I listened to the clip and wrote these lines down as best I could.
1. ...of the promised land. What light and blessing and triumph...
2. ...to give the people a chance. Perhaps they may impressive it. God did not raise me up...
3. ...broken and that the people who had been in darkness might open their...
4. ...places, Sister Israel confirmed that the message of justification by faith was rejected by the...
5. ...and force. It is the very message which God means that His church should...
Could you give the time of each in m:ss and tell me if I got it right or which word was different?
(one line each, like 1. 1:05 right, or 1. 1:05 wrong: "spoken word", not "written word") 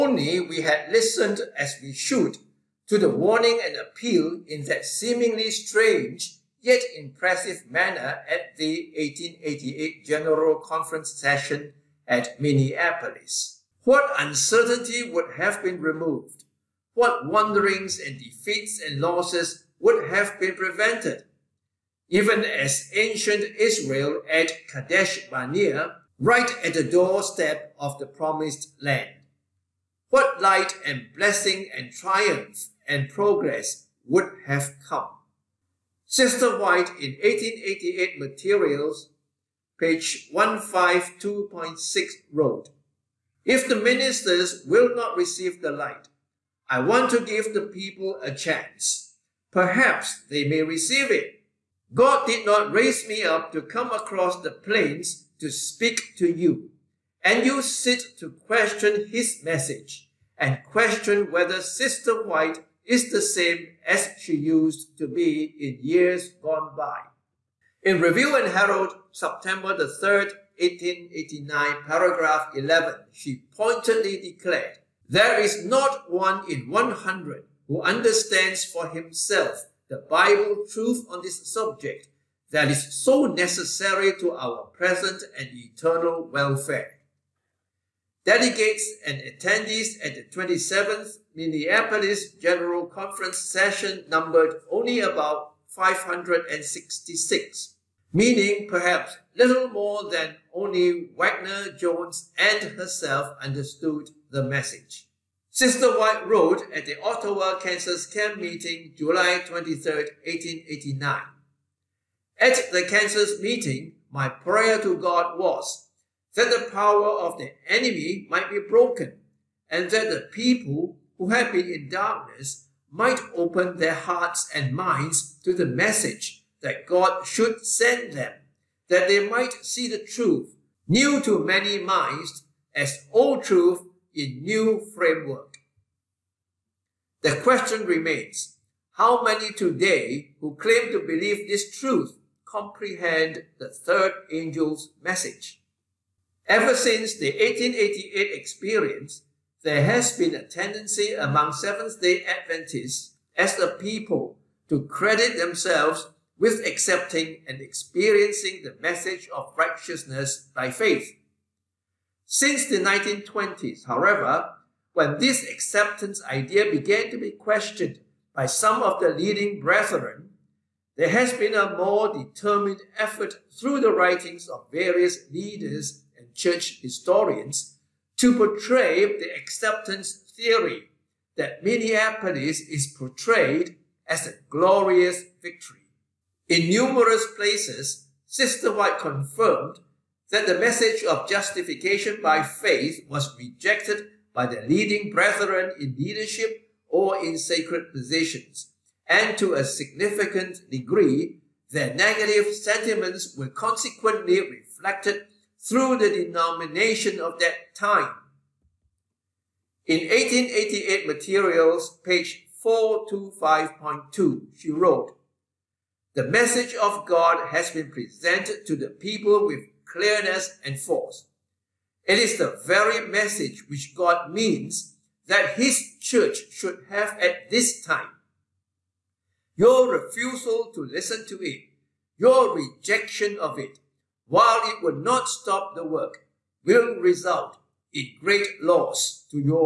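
1. 0:27 right
2. 0:47 wrong: "receive", not "impressive"
3. 1:58 right
4. 3:07 wrong: "White", not "Israel"
5. 3:40 right.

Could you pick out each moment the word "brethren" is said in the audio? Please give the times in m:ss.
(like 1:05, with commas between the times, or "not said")
2:49, 3:15.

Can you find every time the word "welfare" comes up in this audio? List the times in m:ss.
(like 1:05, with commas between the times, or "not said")
1:26.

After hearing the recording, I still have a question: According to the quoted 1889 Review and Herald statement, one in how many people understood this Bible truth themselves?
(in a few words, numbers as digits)
100.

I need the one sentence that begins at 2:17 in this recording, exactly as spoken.
The question remains, how many today who claim to believe this truth comprehend the third angel's message?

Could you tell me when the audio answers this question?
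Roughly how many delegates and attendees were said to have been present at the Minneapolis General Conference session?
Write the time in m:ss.
1:35.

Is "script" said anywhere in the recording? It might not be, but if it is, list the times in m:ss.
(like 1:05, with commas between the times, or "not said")
not said.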